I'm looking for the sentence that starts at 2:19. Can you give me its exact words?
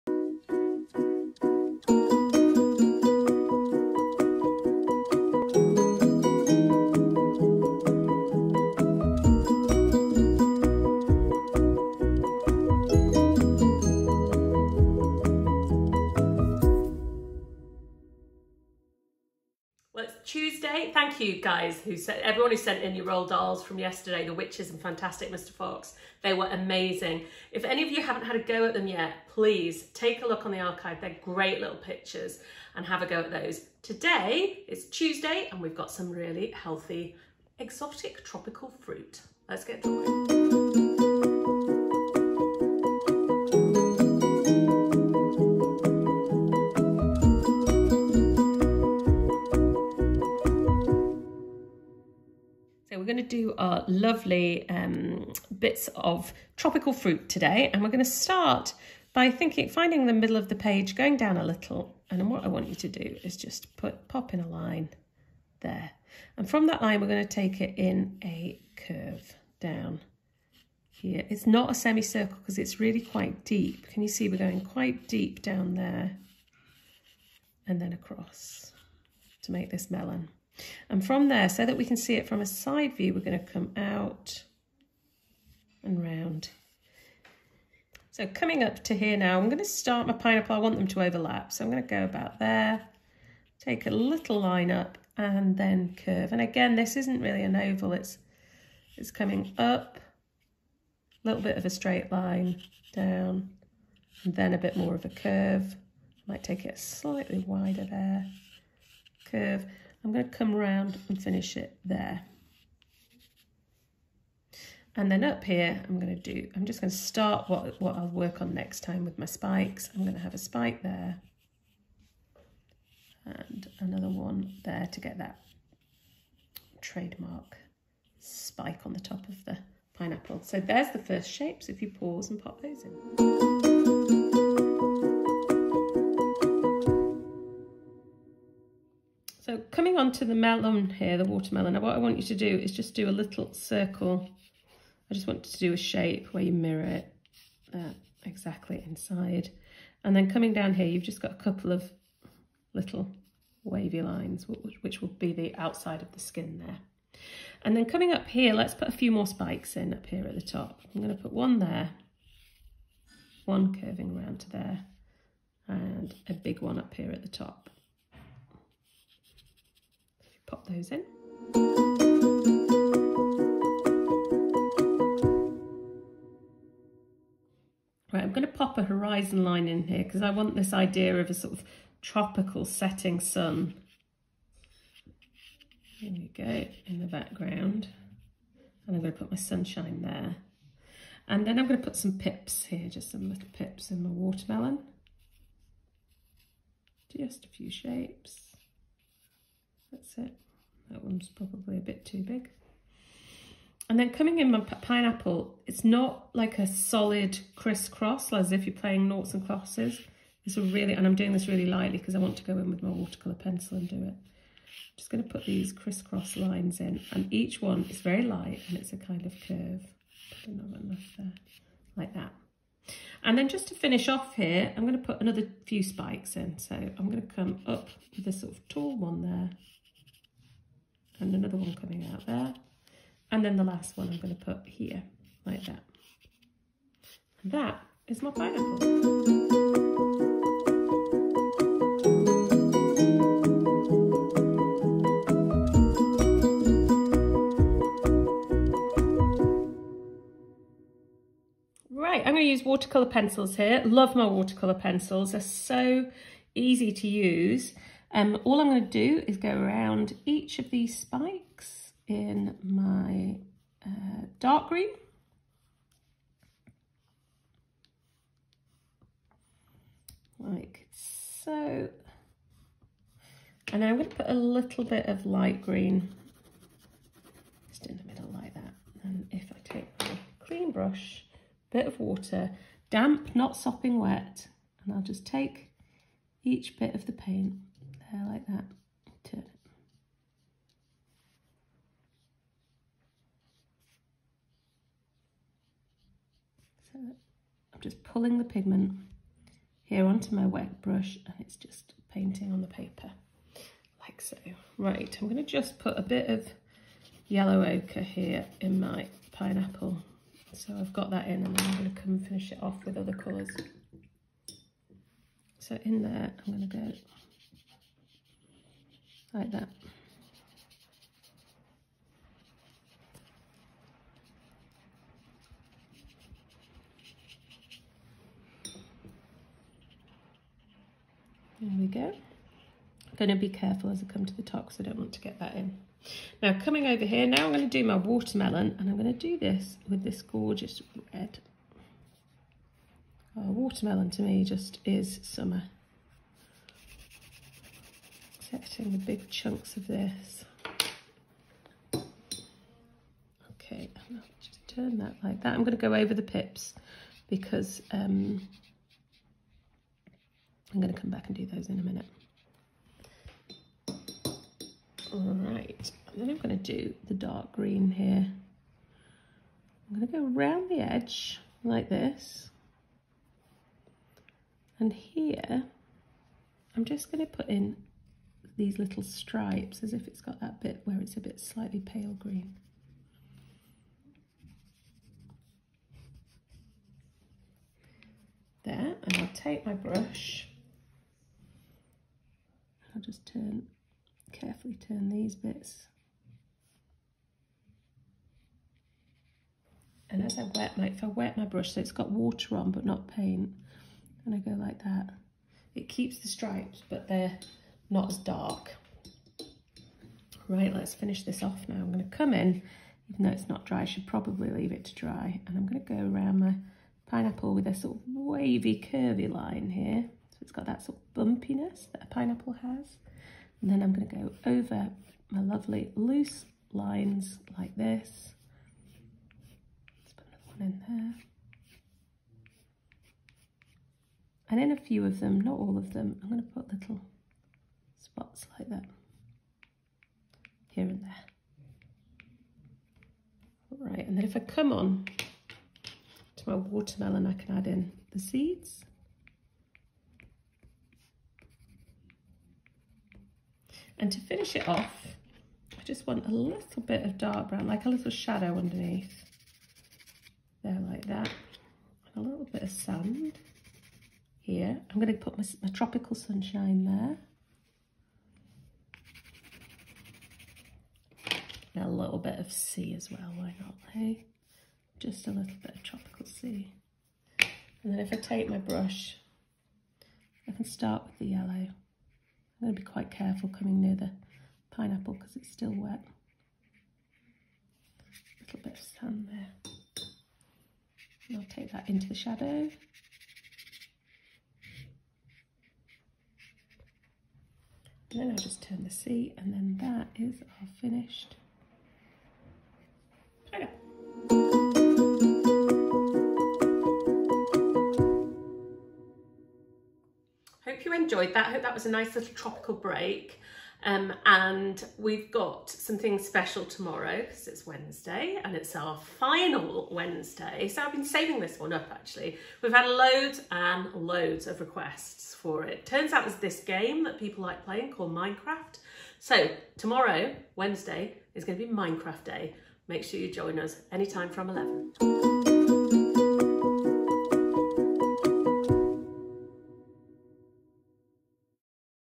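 So coming on to the melon here, the watermelon, what I want you to do is just do a little circle.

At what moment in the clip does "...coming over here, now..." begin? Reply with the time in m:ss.
5:36.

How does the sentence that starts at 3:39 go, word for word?
I do enough there, like that.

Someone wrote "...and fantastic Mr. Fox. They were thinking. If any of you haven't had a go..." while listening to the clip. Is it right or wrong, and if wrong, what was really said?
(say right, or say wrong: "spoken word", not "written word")
wrong: "amazing", not "thinking".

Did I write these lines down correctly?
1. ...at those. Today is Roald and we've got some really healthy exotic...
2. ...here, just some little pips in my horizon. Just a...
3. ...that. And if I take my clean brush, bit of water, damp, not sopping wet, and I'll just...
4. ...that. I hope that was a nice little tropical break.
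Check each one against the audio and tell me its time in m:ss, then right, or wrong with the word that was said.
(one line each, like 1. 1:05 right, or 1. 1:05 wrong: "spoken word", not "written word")
1. 0:33 wrong: "Tuesday", not "Roald"
2. 3:12 wrong: "watermelon", not "horizon"
3. 4:38 right
4. 8:31 right.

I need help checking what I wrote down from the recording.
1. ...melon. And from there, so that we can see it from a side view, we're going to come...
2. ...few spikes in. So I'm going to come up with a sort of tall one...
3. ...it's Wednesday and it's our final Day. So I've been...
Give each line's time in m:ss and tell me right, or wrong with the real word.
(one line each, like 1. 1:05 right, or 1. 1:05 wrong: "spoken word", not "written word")
1. 1:19 right
2. 3:45 right
3. 8:37 wrong: "Wednesday", not "Day".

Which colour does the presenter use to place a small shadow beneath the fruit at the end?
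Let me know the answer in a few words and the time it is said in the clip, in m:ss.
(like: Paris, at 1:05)
dark brown, at 7:37.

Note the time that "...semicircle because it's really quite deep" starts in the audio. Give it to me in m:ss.
1:11.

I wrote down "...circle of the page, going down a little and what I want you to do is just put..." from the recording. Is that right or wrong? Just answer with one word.
wrong.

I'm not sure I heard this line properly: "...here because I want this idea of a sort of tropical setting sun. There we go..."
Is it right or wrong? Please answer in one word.
right.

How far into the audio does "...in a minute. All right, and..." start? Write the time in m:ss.
6:01.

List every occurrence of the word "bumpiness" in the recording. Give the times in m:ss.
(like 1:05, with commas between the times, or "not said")
7:01.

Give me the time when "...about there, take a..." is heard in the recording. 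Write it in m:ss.
1:32.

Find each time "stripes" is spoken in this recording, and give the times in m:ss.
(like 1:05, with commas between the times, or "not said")
6:19, 6:46.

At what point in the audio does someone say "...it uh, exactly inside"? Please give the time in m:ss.
2:26.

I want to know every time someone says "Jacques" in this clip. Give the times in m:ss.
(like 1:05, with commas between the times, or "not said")
not said.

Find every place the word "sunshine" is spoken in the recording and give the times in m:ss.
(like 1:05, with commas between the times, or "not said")
3:09, 7:46.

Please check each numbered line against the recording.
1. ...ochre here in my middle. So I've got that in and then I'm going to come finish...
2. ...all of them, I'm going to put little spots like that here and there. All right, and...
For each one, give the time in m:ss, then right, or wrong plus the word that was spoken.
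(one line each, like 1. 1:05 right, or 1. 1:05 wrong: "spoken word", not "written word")
1. 5:07 wrong: "pineapple", not "middle"
2. 7:15 right.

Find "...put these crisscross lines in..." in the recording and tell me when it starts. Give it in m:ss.
3:35.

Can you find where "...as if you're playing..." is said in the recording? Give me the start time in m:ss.
3:28.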